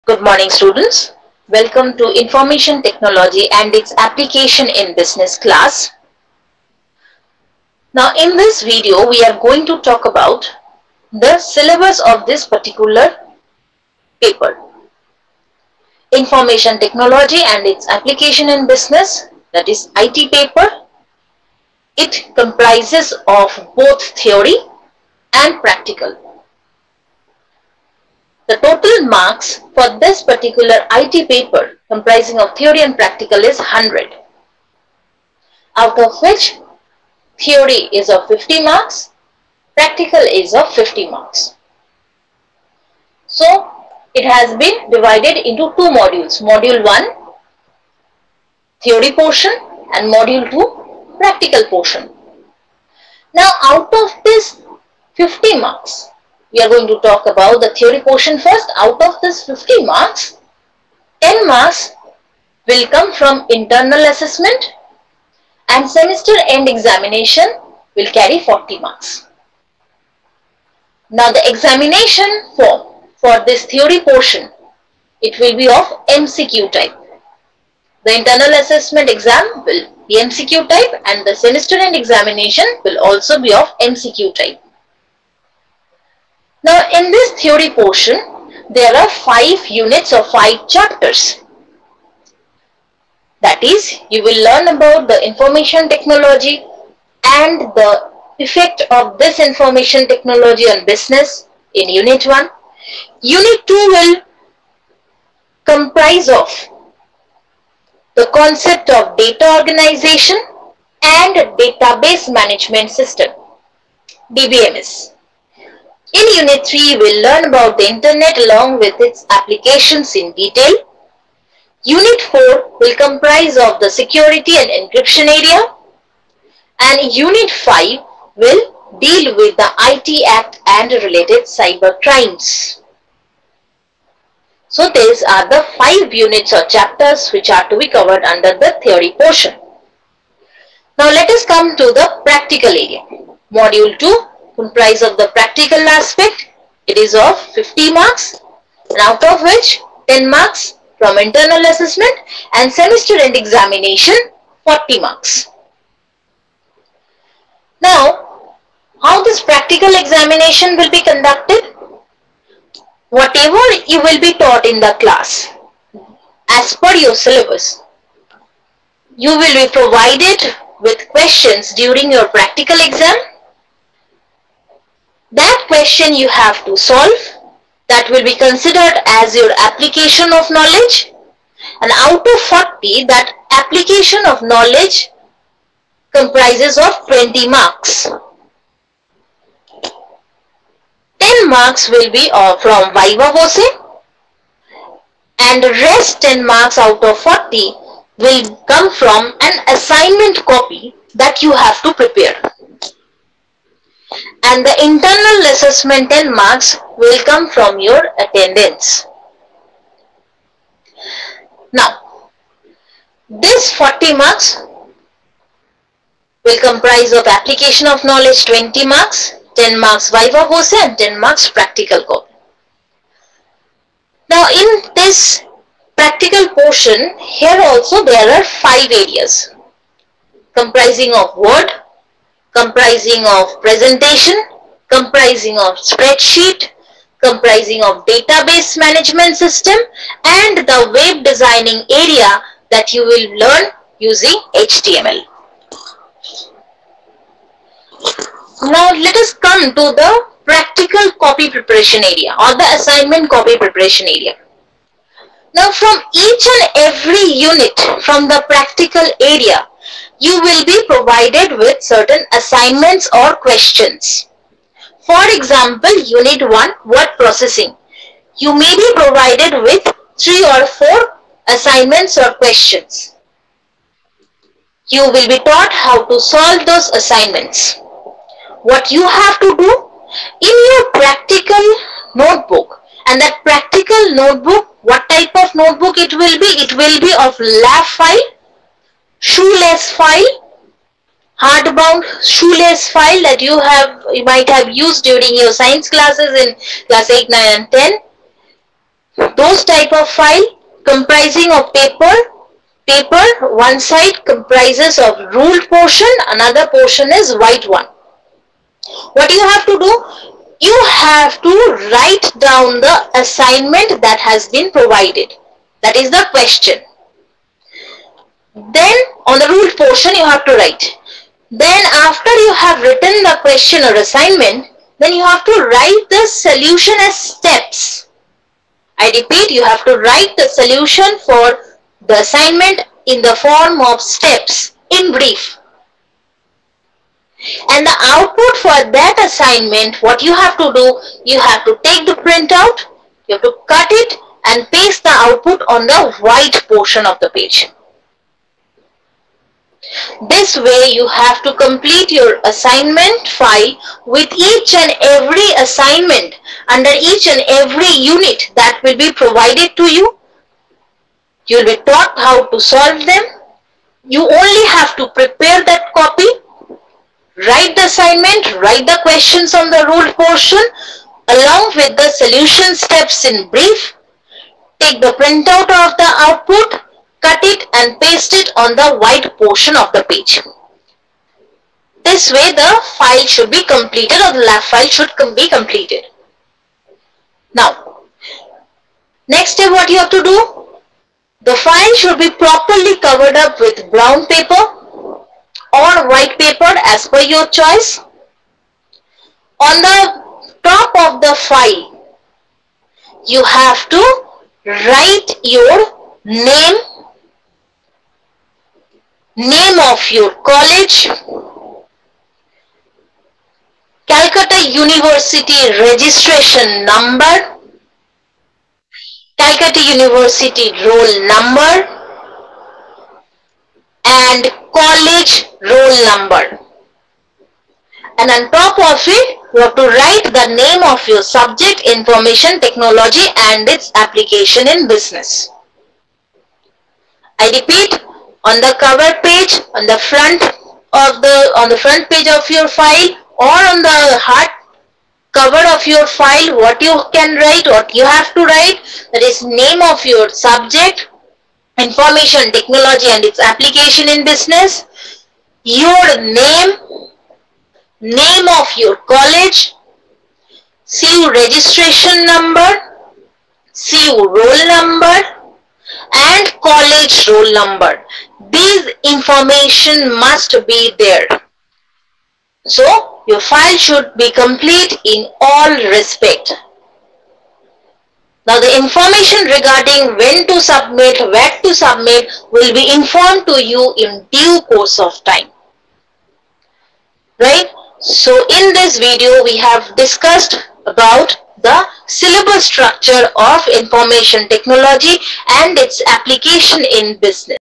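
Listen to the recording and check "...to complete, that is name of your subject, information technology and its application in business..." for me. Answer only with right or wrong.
wrong.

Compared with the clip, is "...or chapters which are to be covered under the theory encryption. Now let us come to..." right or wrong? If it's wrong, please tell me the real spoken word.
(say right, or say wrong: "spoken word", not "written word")
wrong: "portion", not "encryption".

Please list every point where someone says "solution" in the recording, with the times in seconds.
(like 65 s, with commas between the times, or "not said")
326 s, 330 s, 372 s.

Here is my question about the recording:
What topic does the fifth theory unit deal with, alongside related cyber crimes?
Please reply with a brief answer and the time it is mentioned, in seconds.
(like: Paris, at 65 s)
IT Act, at 129 s.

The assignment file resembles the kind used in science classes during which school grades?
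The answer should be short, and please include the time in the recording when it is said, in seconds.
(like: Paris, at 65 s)
8, 9 and 10, at 296 s.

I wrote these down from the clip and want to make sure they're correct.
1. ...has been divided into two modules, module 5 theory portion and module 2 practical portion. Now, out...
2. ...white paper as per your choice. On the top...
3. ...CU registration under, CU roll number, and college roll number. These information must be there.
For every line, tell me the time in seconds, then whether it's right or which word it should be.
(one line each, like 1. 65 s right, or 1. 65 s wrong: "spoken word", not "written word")
1. 44 s wrong: "1", not "5"
2. 396 s right
3. 460 s wrong: "number", not "under".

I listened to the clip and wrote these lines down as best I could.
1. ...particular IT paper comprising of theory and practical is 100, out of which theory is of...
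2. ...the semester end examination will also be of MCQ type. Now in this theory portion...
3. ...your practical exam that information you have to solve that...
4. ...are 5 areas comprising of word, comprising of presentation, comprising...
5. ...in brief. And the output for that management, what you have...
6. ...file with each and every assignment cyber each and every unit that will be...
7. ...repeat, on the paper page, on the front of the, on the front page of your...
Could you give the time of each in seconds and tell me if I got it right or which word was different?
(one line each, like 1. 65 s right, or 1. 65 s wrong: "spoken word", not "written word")
1. 30 s right
2. 81 s right
3. 172 s wrong: "question", not "information"
4. 228 s right
5. 334 s wrong: "assignment", not "management"
6. 353 s wrong: "under", not "cyber"
7. 437 s wrong: "cover", not "paper".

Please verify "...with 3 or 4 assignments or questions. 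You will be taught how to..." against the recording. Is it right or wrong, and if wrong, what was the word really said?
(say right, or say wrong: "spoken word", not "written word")
right.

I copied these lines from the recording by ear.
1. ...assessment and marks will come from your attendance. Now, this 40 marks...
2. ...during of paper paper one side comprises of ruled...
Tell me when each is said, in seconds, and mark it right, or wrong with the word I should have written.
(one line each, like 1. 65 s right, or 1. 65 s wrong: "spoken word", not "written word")
1. 205 s right
2. 300 s wrong: "comprising", not "during".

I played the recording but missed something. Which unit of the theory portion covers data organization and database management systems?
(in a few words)
Unit 2.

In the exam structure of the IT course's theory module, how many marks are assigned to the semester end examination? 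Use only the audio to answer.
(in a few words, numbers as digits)
40.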